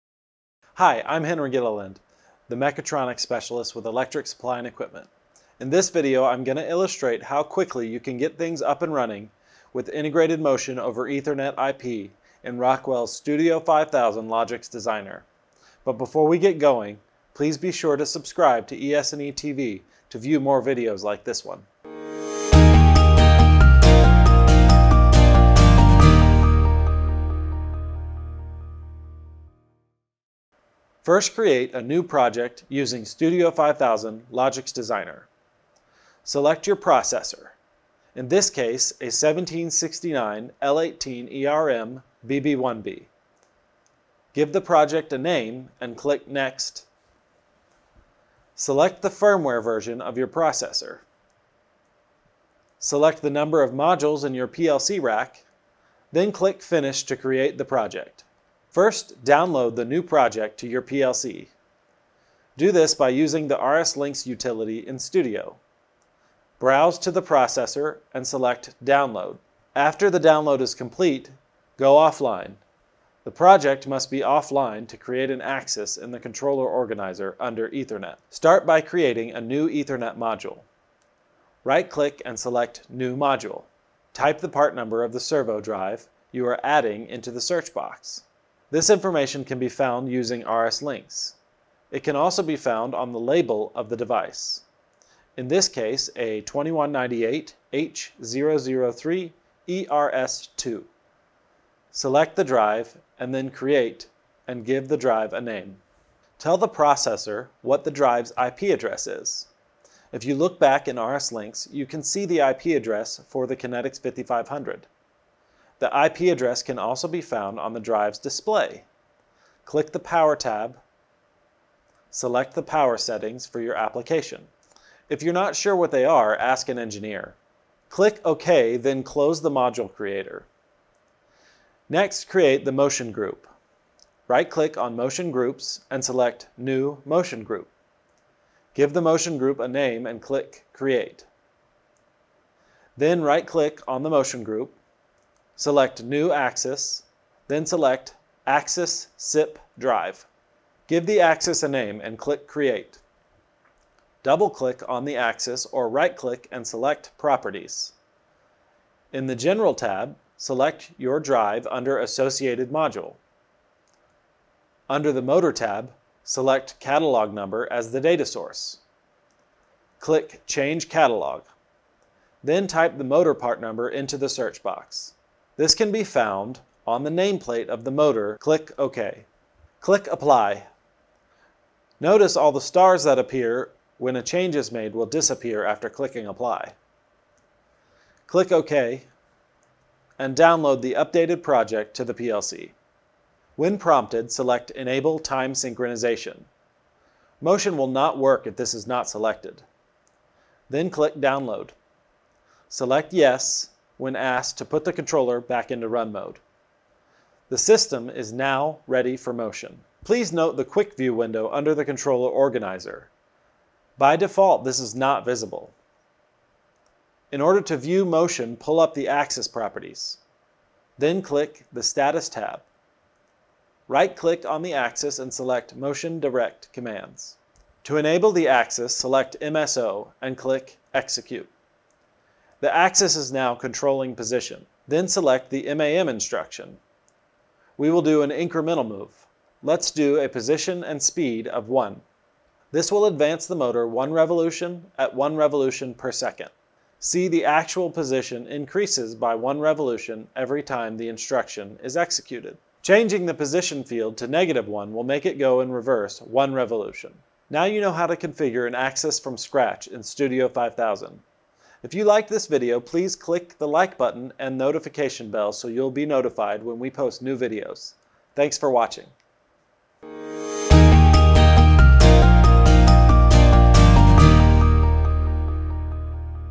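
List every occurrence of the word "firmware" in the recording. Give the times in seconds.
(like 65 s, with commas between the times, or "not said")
49 s.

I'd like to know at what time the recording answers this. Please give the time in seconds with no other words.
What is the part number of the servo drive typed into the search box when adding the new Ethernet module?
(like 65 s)
96 s.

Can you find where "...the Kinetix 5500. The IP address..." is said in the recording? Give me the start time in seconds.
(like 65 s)
113 s.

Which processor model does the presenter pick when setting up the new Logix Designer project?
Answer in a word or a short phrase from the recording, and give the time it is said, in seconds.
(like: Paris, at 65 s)
1769 L18 ERM BB1B, at 39 s.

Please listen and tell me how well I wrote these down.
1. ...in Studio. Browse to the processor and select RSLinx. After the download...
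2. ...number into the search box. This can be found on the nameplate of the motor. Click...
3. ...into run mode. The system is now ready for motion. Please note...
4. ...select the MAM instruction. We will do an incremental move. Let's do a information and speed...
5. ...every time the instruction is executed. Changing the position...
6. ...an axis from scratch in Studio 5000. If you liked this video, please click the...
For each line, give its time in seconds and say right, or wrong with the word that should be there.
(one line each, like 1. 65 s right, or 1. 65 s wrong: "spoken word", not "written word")
1. 64 s wrong: "Download", not "RSLinx"
2. 173 s right
3. 205 s right
4. 235 s wrong: "position", not "information"
5. 250 s right
6. 258 s right.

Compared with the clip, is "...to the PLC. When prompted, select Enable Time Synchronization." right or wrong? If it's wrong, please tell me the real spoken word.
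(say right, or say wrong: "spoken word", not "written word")
right.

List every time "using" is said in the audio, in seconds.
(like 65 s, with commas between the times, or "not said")
32 s, 63 s, 90 s.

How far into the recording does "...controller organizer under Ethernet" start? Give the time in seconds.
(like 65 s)
76 s.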